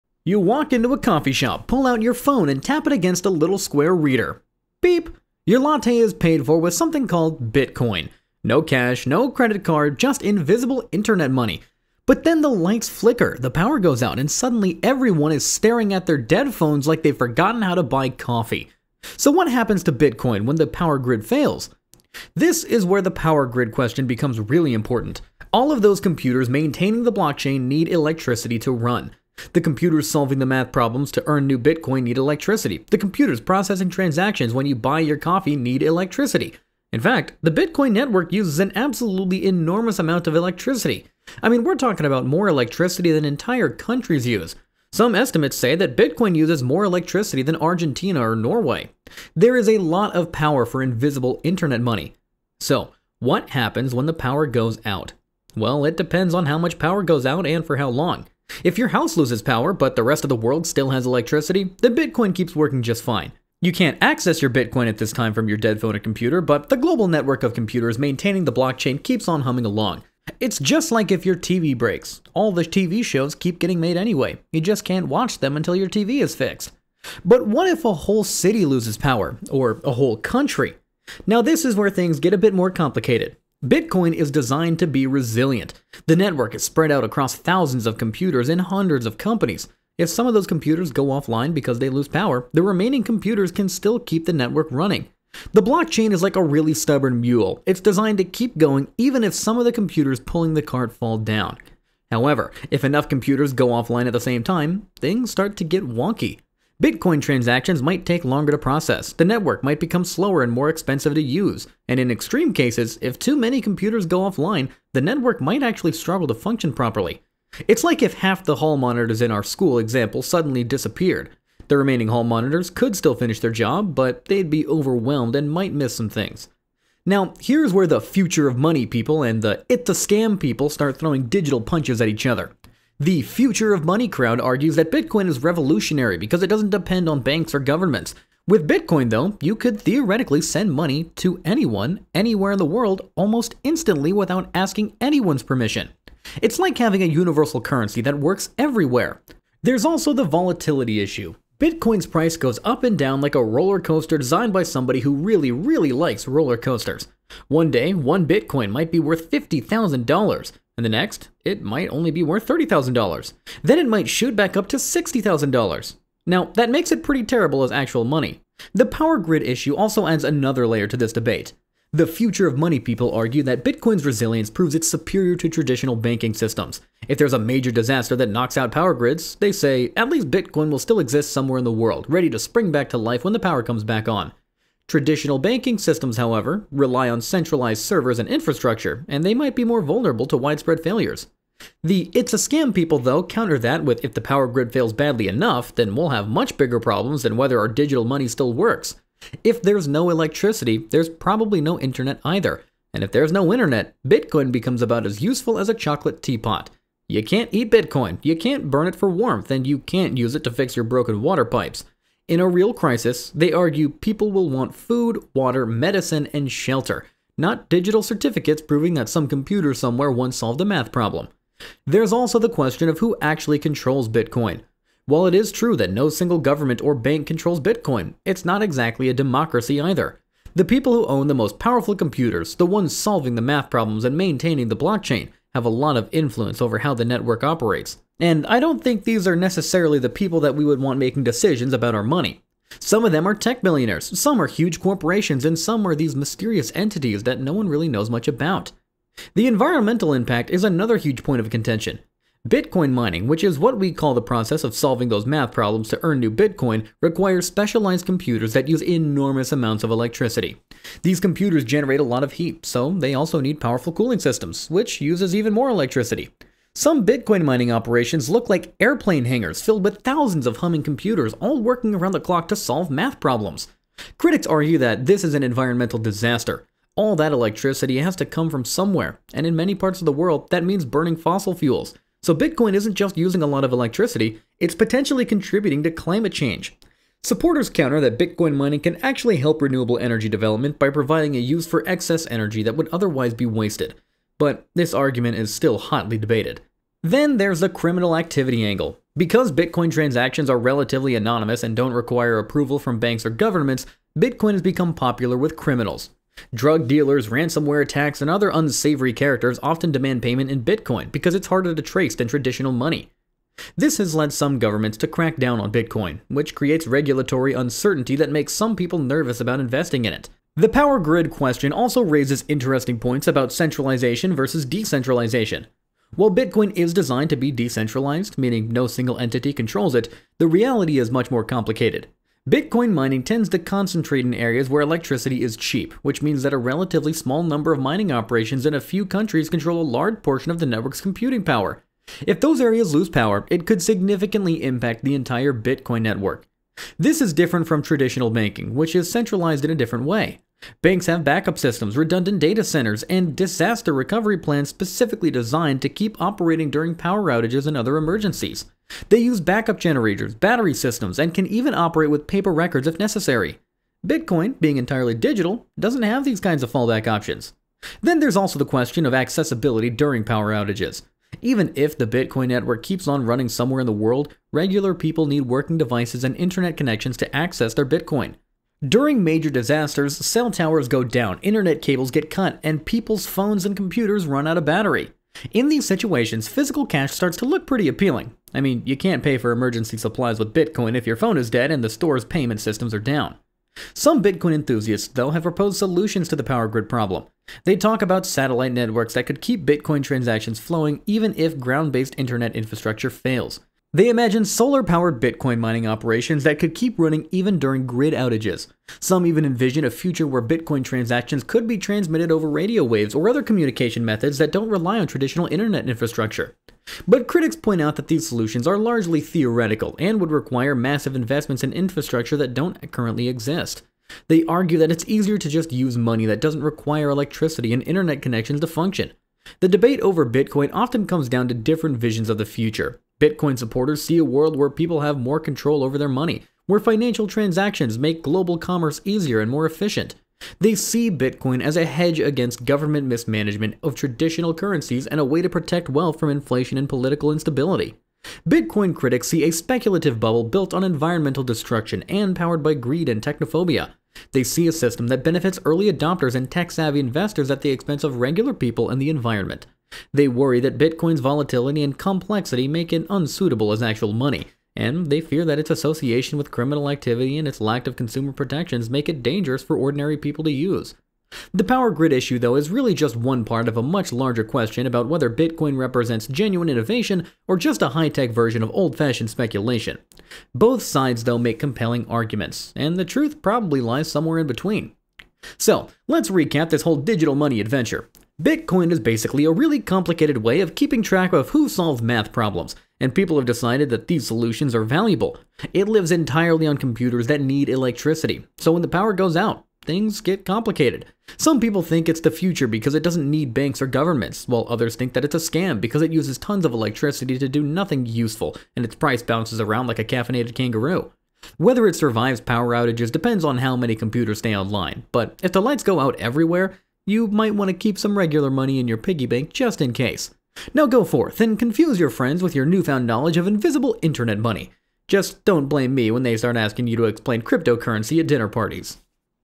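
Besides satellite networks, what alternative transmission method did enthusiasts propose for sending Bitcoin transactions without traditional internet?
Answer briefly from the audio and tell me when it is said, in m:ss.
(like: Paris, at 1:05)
radio waves, at 6:52.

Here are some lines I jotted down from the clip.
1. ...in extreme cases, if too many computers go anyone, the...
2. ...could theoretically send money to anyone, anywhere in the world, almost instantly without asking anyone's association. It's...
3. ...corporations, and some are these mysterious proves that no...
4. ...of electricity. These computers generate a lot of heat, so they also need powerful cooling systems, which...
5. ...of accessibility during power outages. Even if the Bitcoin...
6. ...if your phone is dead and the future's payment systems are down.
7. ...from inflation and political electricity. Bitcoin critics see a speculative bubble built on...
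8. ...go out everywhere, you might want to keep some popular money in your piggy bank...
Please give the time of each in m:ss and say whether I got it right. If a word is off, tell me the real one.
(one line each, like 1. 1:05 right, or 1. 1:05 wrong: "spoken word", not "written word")
1. 1:51 wrong: "offline", not "anyone"
2. 2:19 wrong: "permission", not "association"
3. 4:04 wrong: "entities", not "proves"
4. 4:19 right
5. 6:09 right
6. 6:30 wrong: "store", not "future"
7. 7:26 wrong: "instability", not "electricity"
8. 8:35 wrong: "regular", not "popular".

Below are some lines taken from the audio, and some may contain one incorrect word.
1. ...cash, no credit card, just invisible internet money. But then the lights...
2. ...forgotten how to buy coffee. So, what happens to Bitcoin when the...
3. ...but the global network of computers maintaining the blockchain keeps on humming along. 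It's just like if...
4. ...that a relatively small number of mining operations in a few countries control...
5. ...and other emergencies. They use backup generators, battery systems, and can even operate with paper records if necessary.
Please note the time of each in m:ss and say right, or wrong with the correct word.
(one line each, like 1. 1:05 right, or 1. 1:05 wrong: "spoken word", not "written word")
1. 0:08 right
2. 0:17 right
3. 1:06 right
4. 5:36 right
5. 5:57 right.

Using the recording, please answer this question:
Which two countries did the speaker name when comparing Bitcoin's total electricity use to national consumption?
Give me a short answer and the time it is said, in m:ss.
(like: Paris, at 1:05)
Argentina or Norway, at 0:47.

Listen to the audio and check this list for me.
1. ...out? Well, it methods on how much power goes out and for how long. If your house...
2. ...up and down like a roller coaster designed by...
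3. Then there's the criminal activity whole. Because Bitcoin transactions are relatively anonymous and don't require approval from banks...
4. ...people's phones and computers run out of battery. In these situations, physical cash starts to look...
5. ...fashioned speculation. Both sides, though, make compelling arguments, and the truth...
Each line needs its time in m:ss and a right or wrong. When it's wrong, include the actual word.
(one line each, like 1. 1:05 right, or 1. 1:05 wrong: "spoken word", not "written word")
1. 0:54 wrong: "depends", not "methods"
2. 2:32 right
3. 4:57 wrong: "angle", not "whole"
4. 6:22 right
5. 7:58 right.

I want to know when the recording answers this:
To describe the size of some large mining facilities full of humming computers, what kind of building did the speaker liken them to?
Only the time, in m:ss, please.
4:28.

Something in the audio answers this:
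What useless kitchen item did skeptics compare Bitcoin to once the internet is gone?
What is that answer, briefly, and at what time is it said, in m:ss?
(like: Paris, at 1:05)
chocolate teapot, at 3:25.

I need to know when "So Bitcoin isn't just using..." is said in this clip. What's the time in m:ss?
4:42.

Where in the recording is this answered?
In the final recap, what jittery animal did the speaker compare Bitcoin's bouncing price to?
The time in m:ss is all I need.
8:30.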